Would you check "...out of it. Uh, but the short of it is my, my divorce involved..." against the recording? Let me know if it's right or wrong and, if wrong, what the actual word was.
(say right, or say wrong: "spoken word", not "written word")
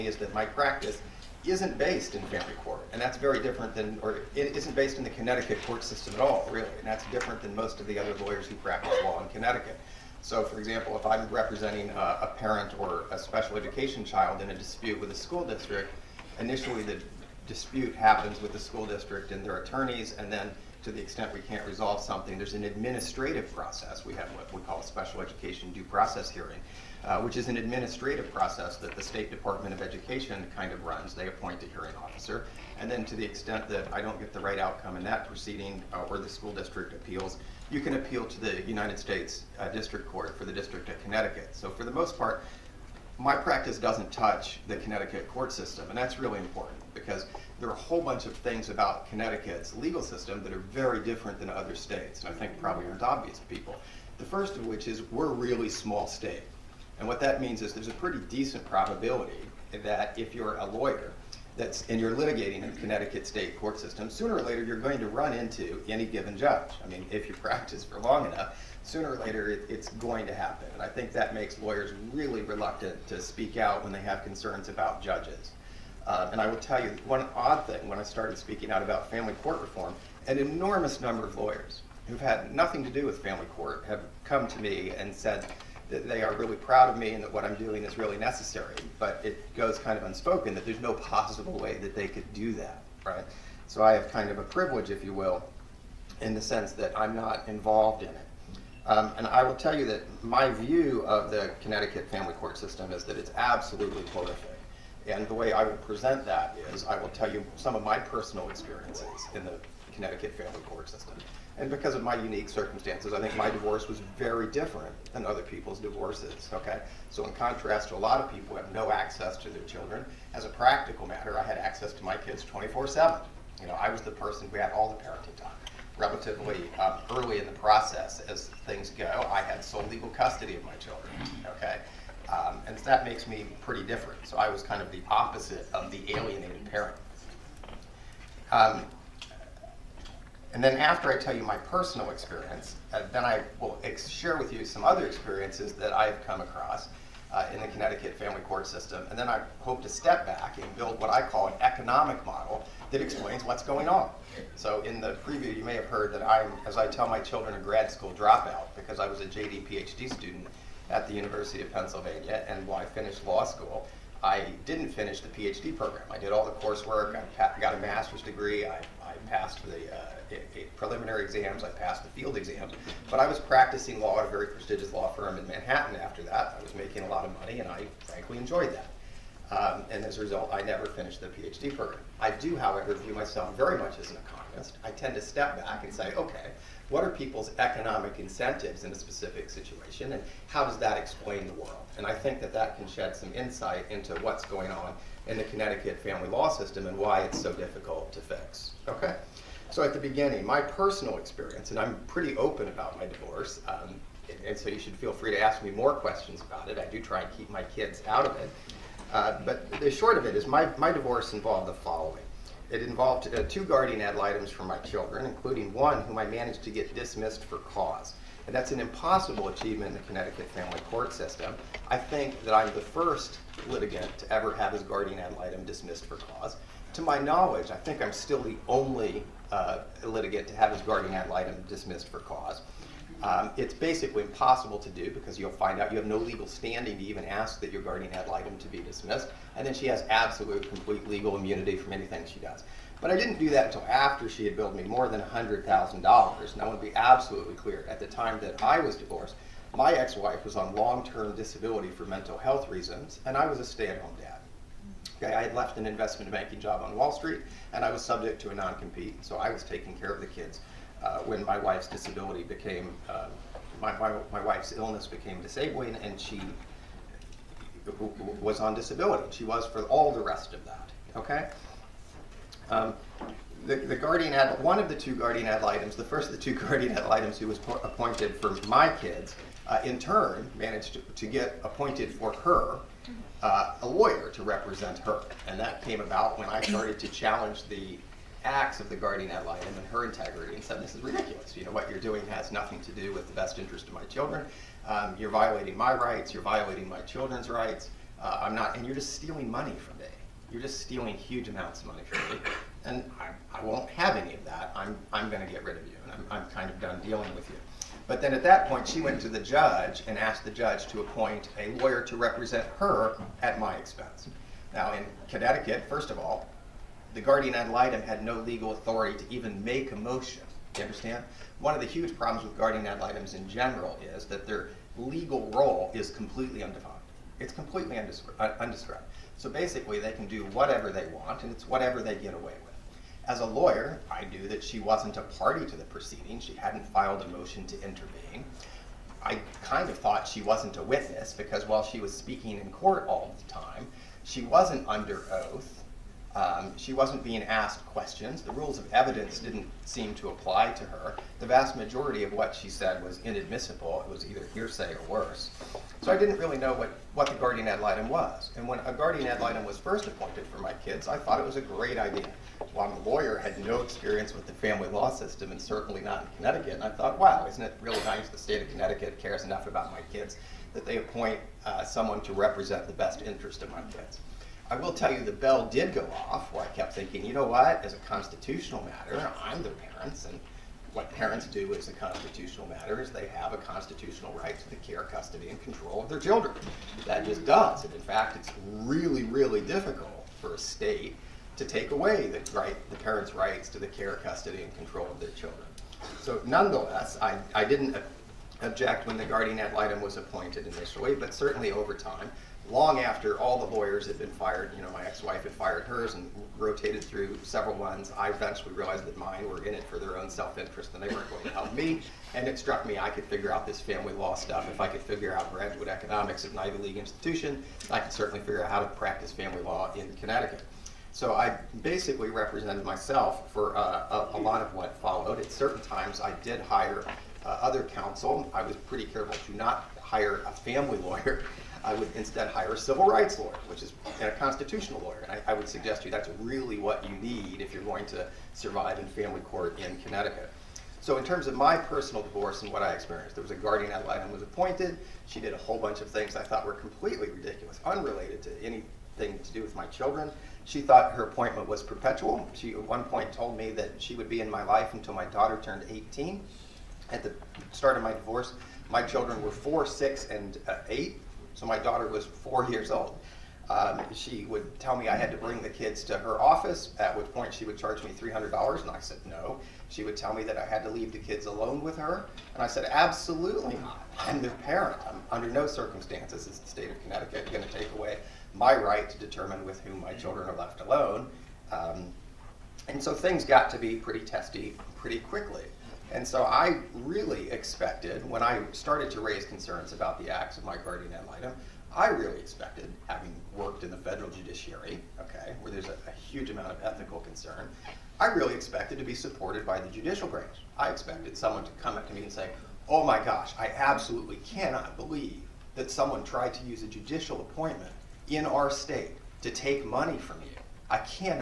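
right.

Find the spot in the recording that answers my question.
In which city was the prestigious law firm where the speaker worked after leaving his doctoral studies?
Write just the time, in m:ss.
2:55.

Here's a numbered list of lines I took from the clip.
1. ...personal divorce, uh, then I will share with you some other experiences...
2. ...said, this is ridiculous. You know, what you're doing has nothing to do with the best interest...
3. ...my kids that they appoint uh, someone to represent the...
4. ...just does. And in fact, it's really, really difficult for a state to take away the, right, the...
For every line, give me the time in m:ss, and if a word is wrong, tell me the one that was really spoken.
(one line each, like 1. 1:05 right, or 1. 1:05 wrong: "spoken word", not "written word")
1. 2:21 wrong: "experience", not "divorce"
2. 4:50 right
3. 6:09 right
4. 6:27 right.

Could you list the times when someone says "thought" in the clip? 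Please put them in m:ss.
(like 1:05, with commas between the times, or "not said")
5:39, 6:01, 6:06, 7:26, 7:30.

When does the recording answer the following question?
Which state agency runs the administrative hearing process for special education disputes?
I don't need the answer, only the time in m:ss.
0:29.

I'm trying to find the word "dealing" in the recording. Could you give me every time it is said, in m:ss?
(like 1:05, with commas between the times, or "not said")
5:07.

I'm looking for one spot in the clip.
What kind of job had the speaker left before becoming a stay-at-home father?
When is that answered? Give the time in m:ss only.
4:15.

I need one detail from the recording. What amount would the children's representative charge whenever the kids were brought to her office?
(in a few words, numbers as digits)
$300.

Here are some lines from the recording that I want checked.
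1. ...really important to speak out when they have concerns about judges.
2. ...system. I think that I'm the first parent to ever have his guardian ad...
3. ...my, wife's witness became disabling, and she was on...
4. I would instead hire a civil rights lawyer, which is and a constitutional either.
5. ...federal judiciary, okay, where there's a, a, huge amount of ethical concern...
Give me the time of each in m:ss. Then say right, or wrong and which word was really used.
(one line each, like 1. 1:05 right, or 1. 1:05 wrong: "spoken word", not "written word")
1. 1:12 wrong: "reluctant", not "important"
2. 3:41 wrong: "litigant", not "parent"
3. 4:24 wrong: "illness", not "witness"
4. 7:11 wrong: "lawyer", not "either"
5. 8:13 right.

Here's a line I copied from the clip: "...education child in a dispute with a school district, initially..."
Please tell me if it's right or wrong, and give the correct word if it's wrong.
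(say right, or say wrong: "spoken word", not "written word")
right.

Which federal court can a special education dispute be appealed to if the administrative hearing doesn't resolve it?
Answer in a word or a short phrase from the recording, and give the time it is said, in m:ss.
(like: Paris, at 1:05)
District Court for the District of Connecticut, at 0:39.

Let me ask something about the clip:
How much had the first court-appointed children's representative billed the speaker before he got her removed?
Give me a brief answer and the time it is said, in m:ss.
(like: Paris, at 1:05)
more than $100,000, at 4:04.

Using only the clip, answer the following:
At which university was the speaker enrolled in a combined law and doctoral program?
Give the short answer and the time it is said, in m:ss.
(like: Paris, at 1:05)
University of Pennsylvania, at 2:41.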